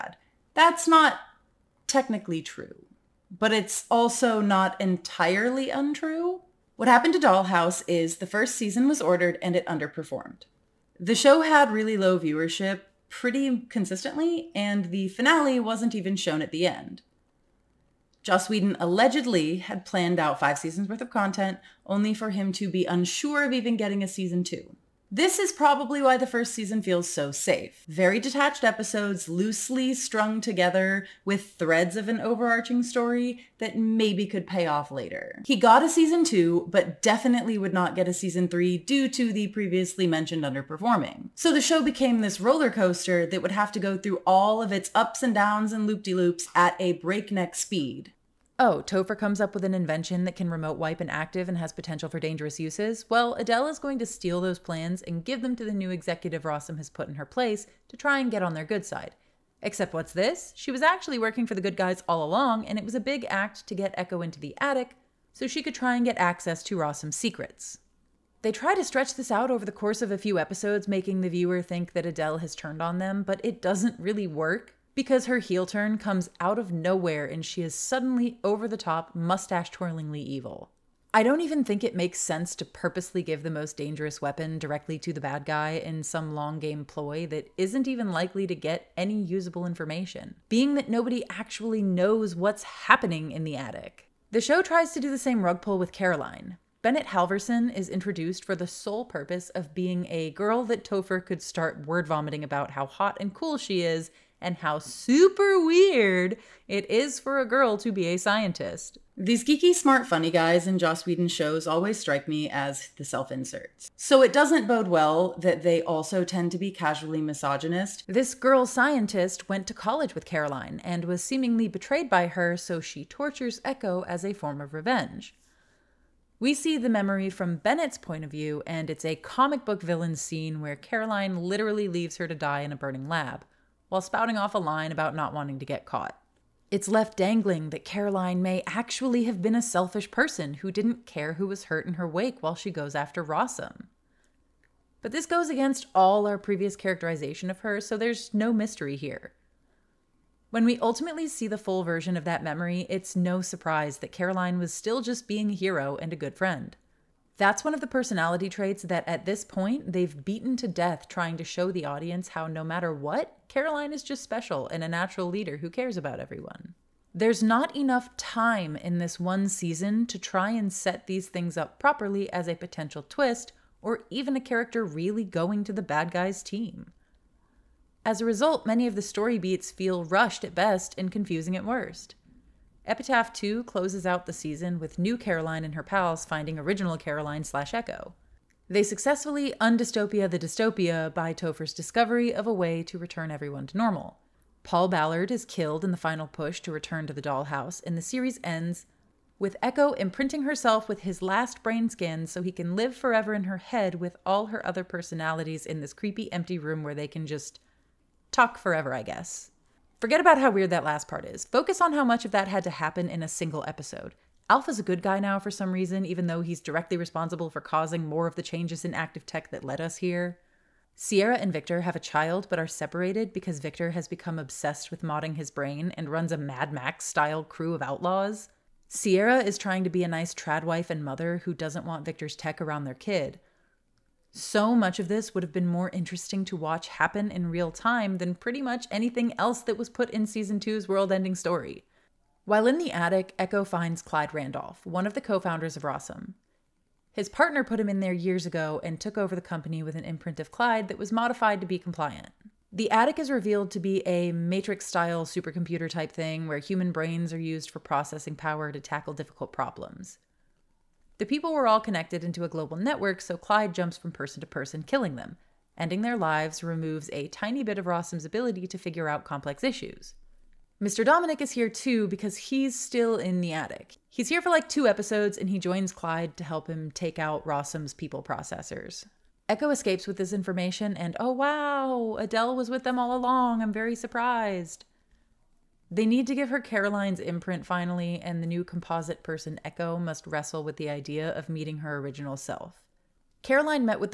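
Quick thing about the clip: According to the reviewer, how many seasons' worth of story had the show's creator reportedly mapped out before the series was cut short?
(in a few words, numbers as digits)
5.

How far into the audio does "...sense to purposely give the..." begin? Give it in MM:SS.
01:22.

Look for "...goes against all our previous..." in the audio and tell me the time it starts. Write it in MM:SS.
02:25.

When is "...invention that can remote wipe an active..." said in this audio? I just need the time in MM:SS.
00:49.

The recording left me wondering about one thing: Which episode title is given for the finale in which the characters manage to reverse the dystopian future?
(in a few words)
Epitaph 2.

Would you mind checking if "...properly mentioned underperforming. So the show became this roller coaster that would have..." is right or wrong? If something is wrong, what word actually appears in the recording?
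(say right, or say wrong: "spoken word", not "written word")
wrong: "previously", not "properly".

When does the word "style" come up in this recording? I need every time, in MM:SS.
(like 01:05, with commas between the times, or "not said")
03:47, 04:14.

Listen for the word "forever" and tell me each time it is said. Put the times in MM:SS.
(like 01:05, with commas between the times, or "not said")
03:22, 03:28.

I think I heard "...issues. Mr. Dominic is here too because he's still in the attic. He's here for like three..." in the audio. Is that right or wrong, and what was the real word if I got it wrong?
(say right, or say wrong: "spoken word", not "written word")
wrong: "two", not "three".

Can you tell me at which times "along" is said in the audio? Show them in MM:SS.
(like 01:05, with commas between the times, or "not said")
01:02, 04:43.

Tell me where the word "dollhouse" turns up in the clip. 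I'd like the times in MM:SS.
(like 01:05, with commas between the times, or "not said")
00:07, 03:17.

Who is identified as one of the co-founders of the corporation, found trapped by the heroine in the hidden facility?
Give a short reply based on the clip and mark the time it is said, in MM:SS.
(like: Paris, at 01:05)
Clyde Randolph, at 04:04.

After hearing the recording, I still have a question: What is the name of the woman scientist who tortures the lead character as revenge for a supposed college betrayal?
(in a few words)
Bennett Halverson.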